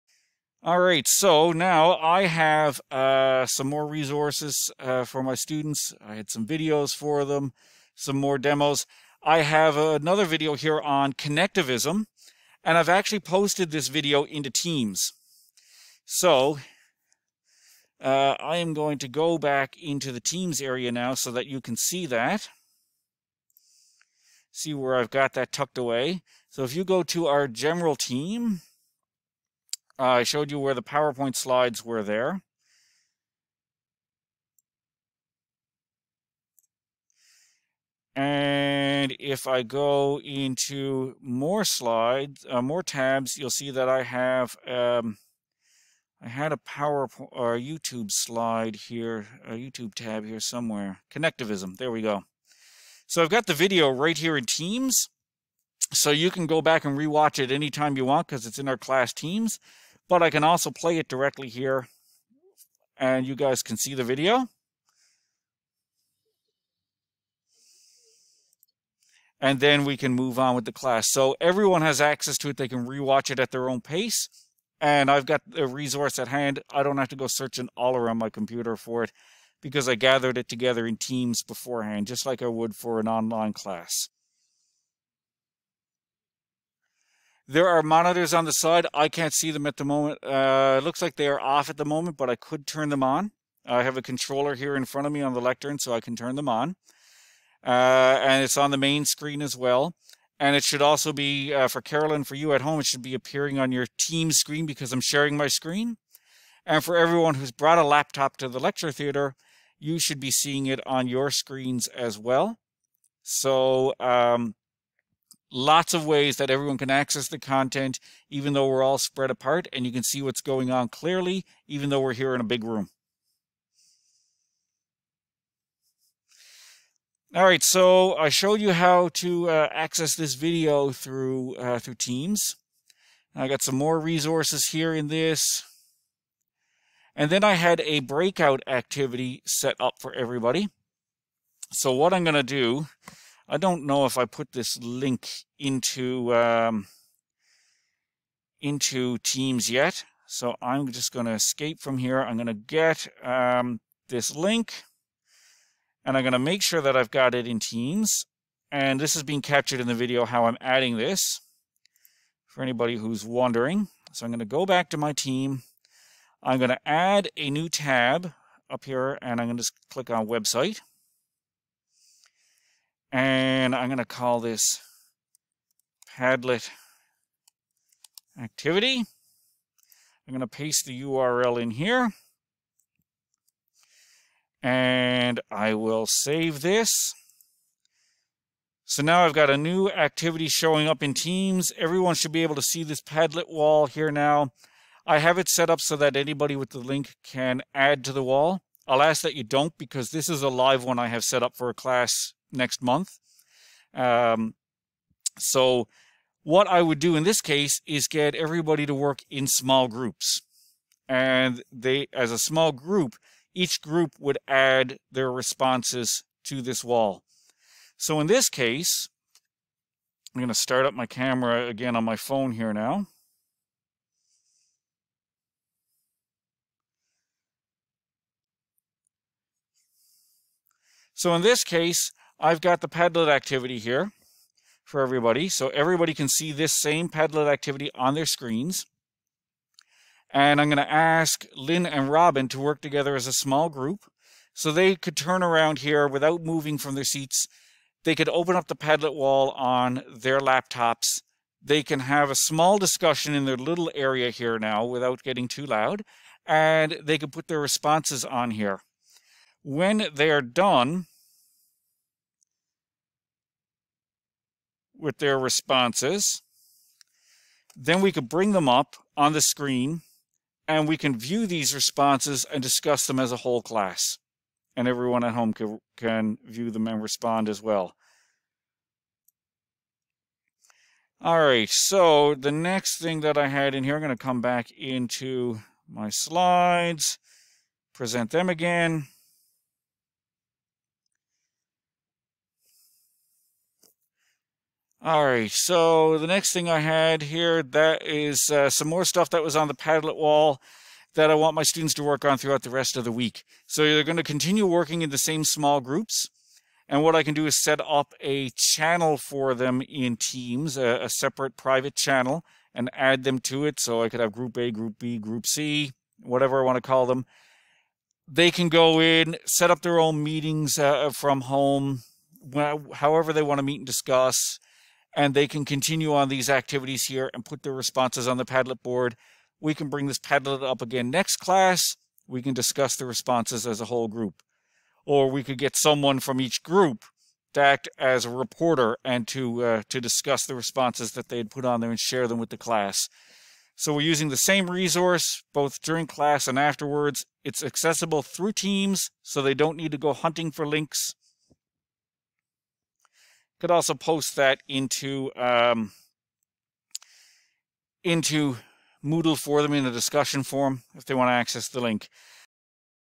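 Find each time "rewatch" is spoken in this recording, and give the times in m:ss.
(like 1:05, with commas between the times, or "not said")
0:56, 1:12.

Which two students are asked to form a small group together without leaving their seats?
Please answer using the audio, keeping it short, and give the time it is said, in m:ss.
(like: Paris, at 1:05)
Lynn and Robin, at 4:01.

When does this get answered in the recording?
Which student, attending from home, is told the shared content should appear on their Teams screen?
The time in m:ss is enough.
1:41.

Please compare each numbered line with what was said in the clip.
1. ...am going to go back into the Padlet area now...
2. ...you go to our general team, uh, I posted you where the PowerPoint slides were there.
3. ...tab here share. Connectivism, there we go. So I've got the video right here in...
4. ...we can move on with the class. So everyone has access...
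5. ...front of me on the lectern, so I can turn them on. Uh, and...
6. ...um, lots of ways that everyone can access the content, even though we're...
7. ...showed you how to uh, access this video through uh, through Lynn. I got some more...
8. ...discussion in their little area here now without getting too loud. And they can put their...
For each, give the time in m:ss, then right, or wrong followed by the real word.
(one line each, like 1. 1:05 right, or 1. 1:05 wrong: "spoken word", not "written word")
1. 0:18 wrong: "Teams", not "Padlet"
2. 0:26 wrong: "showed", not "posted"
3. 0:49 wrong: "somewhere", not "share"
4. 1:09 right
5. 1:34 right
6. 1:53 right
7. 2:08 wrong: "Teams", not "Lynn"
8. 4:12 right.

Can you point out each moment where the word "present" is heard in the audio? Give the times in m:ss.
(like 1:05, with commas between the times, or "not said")
4:47.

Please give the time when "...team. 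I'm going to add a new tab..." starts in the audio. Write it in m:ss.
2:45.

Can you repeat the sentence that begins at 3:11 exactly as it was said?
Everyone should be able to see this Padlet wall here now.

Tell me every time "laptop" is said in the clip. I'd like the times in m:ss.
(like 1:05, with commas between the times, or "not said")
1:47, 4:10.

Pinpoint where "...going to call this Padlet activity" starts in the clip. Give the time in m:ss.
2:53.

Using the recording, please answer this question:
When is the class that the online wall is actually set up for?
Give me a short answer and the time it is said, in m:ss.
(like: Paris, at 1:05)
Next month, at 3:22.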